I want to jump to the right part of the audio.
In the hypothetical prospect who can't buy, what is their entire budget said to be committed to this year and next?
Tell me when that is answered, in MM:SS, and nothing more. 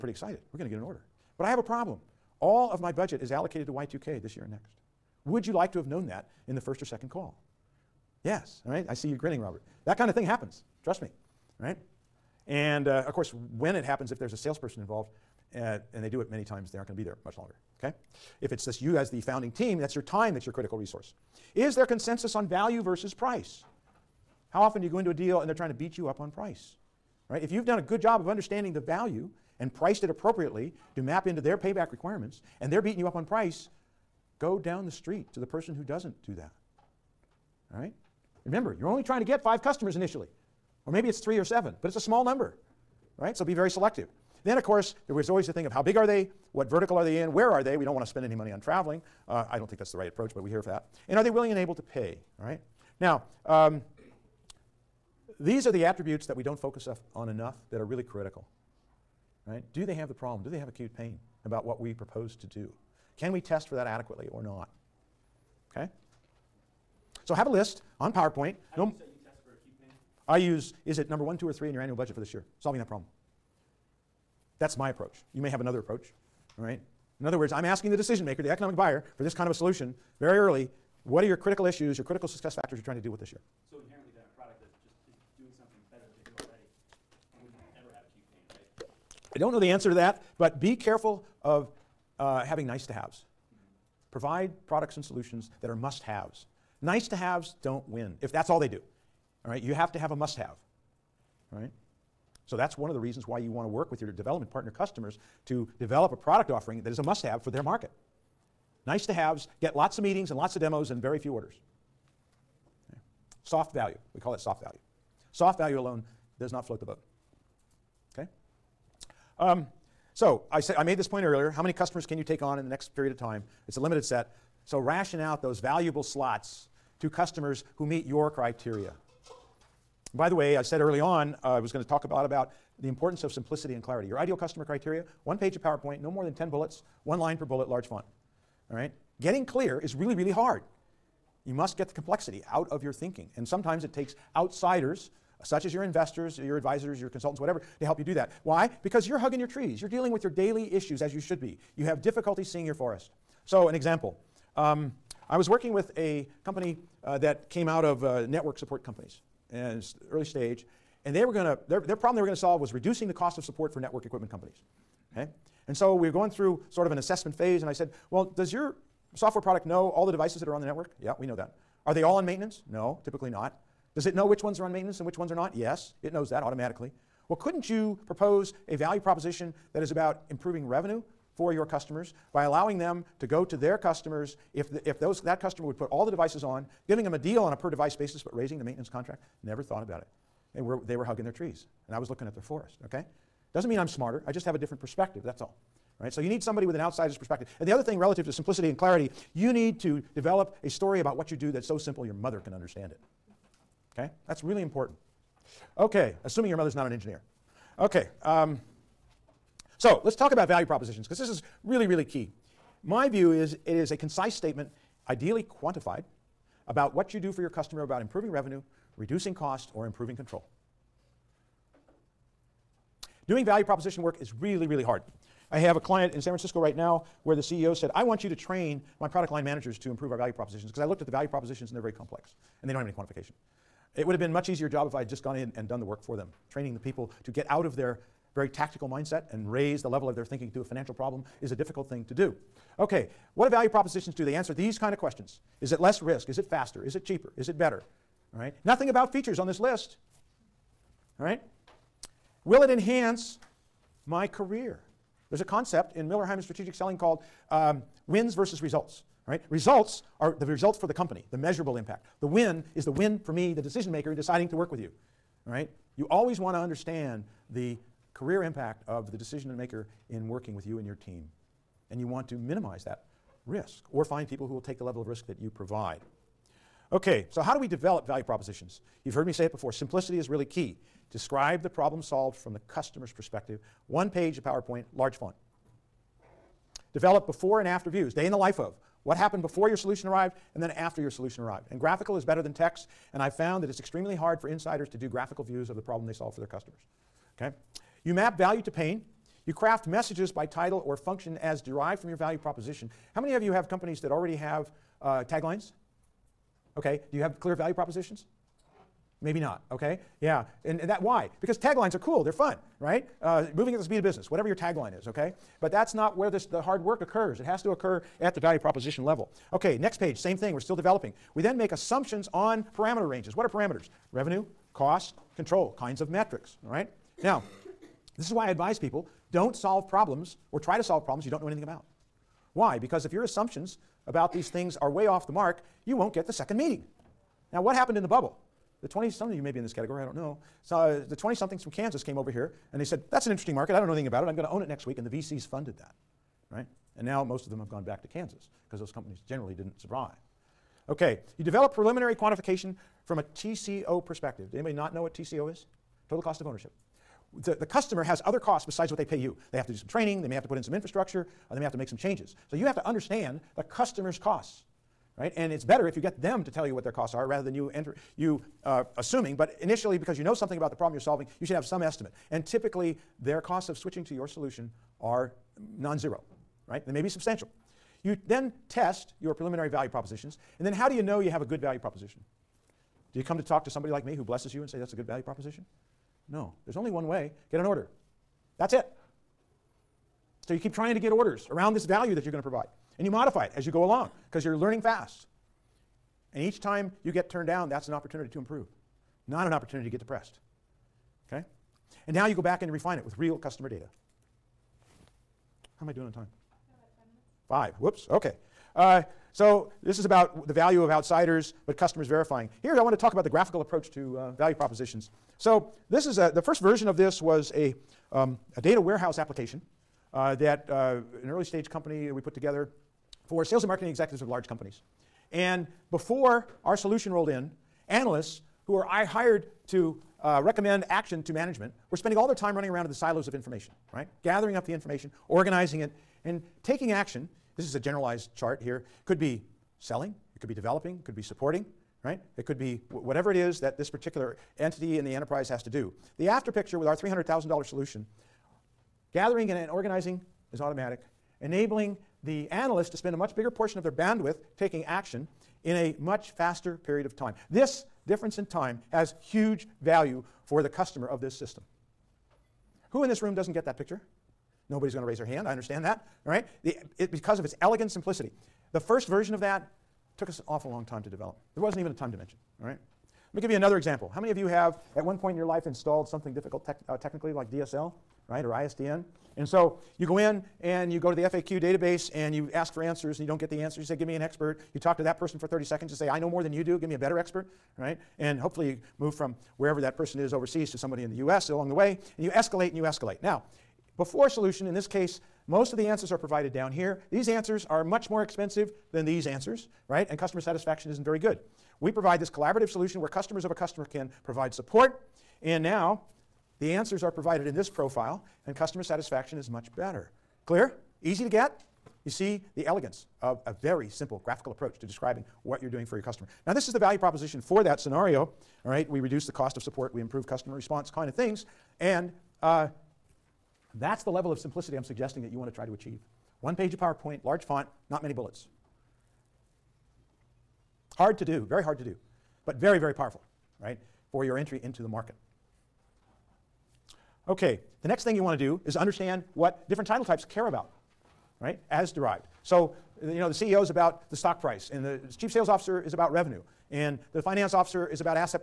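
00:03.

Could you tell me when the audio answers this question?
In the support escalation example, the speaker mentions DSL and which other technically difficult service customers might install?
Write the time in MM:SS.
07:58.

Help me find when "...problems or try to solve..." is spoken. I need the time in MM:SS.
05:29.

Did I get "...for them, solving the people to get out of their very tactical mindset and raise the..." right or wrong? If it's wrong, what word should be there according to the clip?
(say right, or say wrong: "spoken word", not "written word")
wrong: "training", not "solving".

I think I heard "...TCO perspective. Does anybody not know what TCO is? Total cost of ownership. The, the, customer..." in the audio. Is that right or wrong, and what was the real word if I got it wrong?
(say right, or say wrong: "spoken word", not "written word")
right.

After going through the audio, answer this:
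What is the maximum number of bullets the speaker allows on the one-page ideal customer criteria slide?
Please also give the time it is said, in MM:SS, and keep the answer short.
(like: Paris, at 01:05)
10, at 02:15.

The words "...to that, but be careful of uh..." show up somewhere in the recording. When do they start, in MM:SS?
01:29.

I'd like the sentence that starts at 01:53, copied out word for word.
Soft value, we call it soft value.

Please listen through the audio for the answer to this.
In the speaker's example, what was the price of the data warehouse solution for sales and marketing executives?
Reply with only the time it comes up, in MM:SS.
07:26.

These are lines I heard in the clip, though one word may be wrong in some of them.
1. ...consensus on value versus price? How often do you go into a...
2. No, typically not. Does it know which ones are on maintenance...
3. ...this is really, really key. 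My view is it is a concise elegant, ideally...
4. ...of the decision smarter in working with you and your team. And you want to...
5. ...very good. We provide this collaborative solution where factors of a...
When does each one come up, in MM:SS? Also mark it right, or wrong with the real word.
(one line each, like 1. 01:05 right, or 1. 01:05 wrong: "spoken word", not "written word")
1. 00:21 right
2. 02:52 right
3. 03:31 wrong: "statement", not "elegant"
4. 04:28 wrong: "maker", not "smarter"
5. 08:21 wrong: "customers", not "factors".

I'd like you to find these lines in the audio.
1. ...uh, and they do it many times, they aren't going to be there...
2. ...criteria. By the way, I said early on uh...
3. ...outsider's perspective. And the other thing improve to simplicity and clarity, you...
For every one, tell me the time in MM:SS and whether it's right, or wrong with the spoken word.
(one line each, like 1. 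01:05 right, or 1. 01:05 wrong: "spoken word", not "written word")
1. 00:15 right
2. 02:08 right
3. 03:16 wrong: "relative", not "improve".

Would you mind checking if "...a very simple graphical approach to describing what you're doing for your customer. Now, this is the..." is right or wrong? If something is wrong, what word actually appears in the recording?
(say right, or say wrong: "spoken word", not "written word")
right.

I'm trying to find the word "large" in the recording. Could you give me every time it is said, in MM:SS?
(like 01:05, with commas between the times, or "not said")
02:17, 04:44, 07:04, 08:47.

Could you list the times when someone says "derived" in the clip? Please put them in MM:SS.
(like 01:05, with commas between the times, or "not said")
05:01, 09:01.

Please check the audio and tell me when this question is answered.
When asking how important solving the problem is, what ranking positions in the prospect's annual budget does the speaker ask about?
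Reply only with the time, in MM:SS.
01:11.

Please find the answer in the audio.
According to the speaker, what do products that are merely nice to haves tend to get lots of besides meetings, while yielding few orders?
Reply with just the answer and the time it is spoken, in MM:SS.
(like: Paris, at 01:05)
demos, at 01:50.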